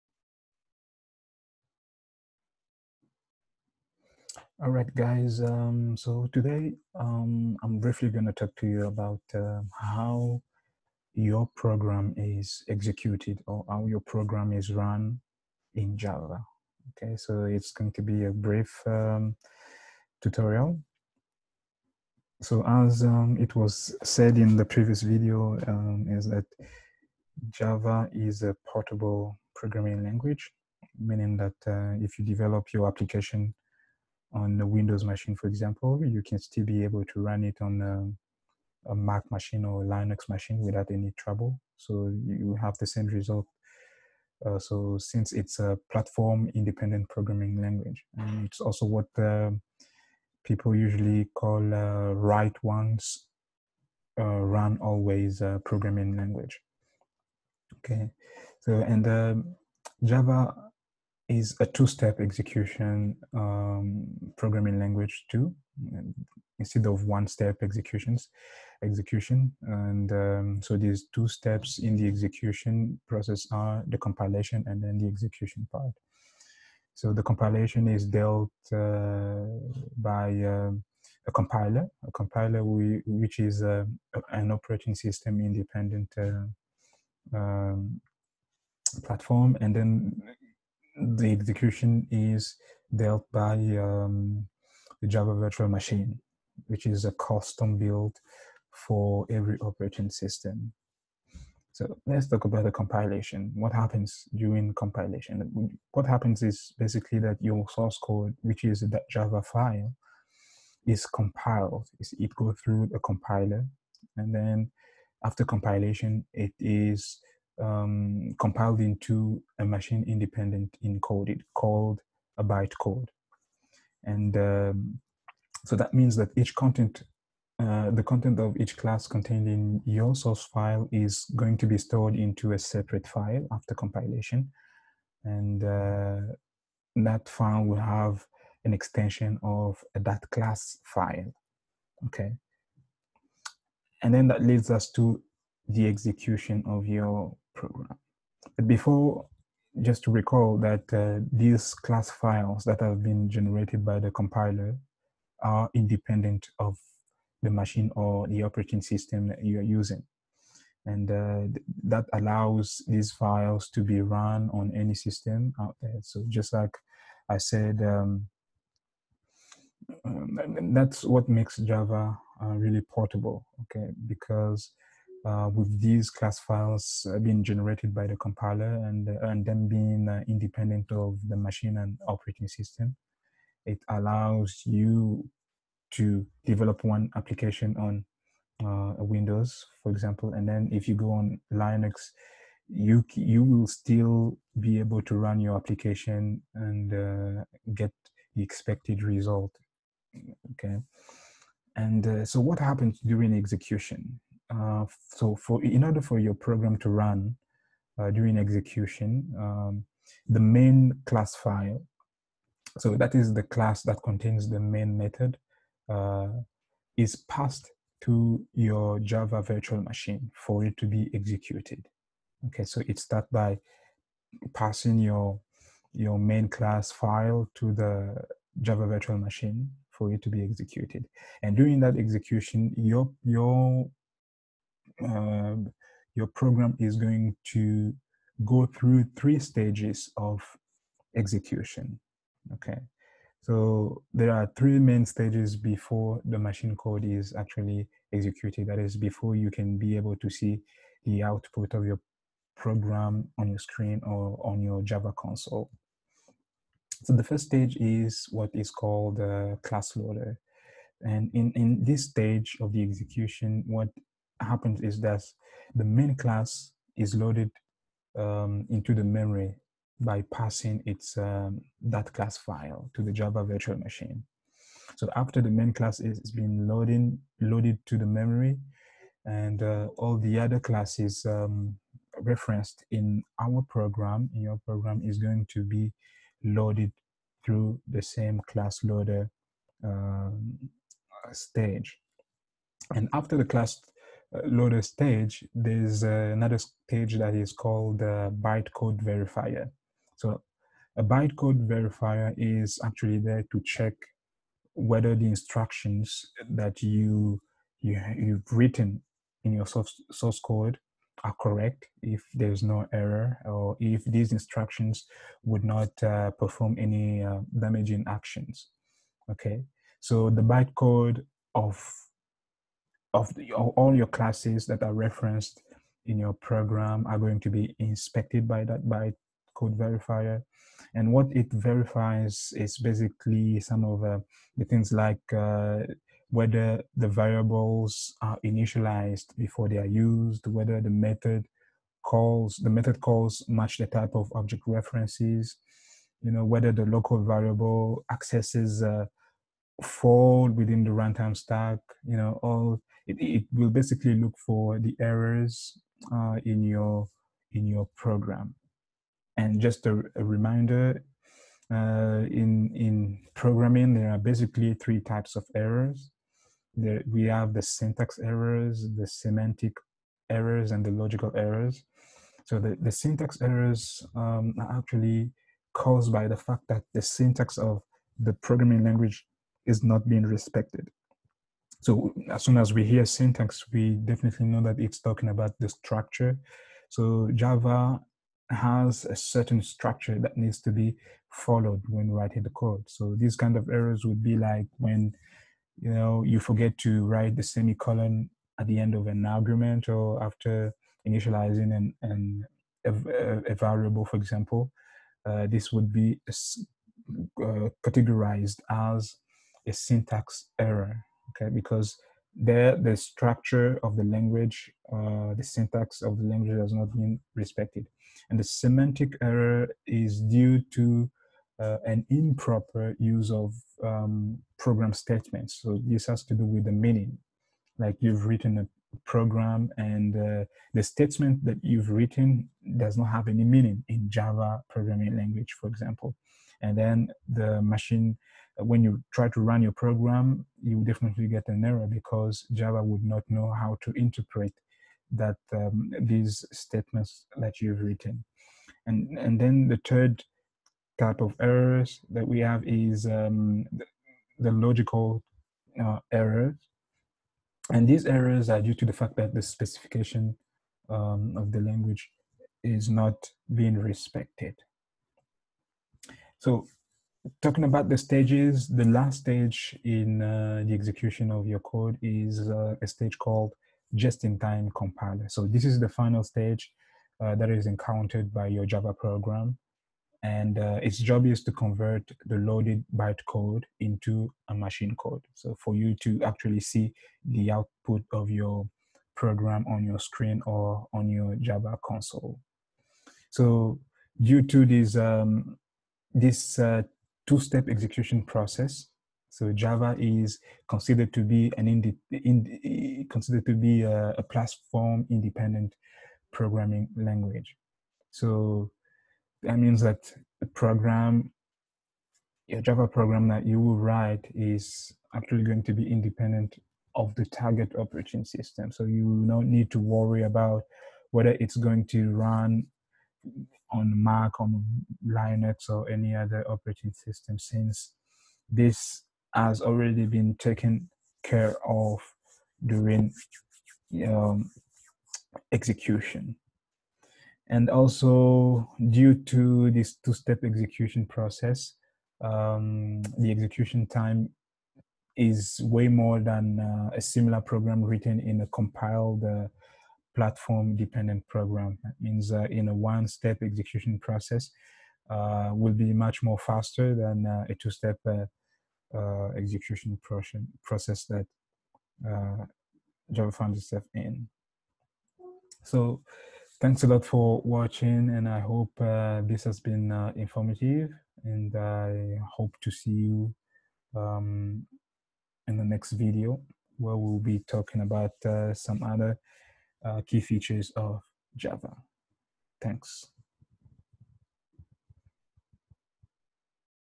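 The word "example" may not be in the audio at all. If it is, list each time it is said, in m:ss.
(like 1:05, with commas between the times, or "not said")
0:35, 3:09, 6:44, 7:15.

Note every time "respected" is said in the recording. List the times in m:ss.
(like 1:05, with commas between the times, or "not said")
6:20, 6:57, 7:43.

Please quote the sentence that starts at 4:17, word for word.
So the first stage is what is called uh, class loader.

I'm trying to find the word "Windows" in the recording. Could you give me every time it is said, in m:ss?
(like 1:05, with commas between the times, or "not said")
0:34, 3:08.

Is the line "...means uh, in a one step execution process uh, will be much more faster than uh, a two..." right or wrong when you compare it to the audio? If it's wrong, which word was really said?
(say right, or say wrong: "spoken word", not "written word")
right.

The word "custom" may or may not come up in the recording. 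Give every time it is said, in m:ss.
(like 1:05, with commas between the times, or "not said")
1:37.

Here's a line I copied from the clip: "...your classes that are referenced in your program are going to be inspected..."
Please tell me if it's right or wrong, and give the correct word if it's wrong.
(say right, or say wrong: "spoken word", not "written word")
right.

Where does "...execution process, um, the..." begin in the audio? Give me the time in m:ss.
9:00.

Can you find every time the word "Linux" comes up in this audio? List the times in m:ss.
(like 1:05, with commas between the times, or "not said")
0:39, 3:11, 8:45.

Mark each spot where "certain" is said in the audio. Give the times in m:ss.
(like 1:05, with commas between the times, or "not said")
6:29.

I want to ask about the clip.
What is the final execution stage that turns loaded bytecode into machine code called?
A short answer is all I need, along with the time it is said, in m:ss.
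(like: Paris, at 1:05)
just-in-time compiler, at 7:53.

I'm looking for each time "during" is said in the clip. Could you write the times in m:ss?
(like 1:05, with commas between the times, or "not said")
1:44, 3:23, 3:28, 3:51, 8:52.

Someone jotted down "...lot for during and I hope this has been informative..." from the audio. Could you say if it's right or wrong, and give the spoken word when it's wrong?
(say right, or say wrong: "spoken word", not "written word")
wrong: "watching", not "during".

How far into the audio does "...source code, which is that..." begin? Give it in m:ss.
1:47.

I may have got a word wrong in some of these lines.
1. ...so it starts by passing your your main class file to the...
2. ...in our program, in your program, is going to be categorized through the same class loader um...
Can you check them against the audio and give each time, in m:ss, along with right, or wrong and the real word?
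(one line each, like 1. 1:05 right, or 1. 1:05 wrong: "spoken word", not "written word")
1. 3:42 right
2. 4:42 wrong: "loaded", not "categorized".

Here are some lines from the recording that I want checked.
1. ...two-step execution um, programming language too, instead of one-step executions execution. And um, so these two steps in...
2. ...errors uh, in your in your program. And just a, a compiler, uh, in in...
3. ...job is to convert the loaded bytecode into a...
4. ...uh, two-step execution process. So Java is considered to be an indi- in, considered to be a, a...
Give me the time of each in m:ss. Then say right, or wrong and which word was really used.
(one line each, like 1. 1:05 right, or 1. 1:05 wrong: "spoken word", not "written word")
1. 1:01 right
2. 5:54 wrong: "reminder", not "compiler"
3. 8:00 right
4. 8:16 right.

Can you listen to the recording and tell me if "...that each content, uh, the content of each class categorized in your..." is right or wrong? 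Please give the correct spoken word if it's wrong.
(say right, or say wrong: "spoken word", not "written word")
wrong: "contained", not "categorized".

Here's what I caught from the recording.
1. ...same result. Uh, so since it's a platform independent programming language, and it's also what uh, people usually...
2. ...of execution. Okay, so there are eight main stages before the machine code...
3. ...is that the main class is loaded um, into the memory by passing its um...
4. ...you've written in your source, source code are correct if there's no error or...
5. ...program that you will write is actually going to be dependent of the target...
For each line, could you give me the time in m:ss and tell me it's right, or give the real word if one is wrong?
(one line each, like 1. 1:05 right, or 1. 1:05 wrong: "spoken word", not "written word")
1. 0:42 right
2. 4:00 wrong: "three", not "eight"
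3. 4:24 right
4. 5:08 right
5. 8:32 wrong: "independent", not "dependent".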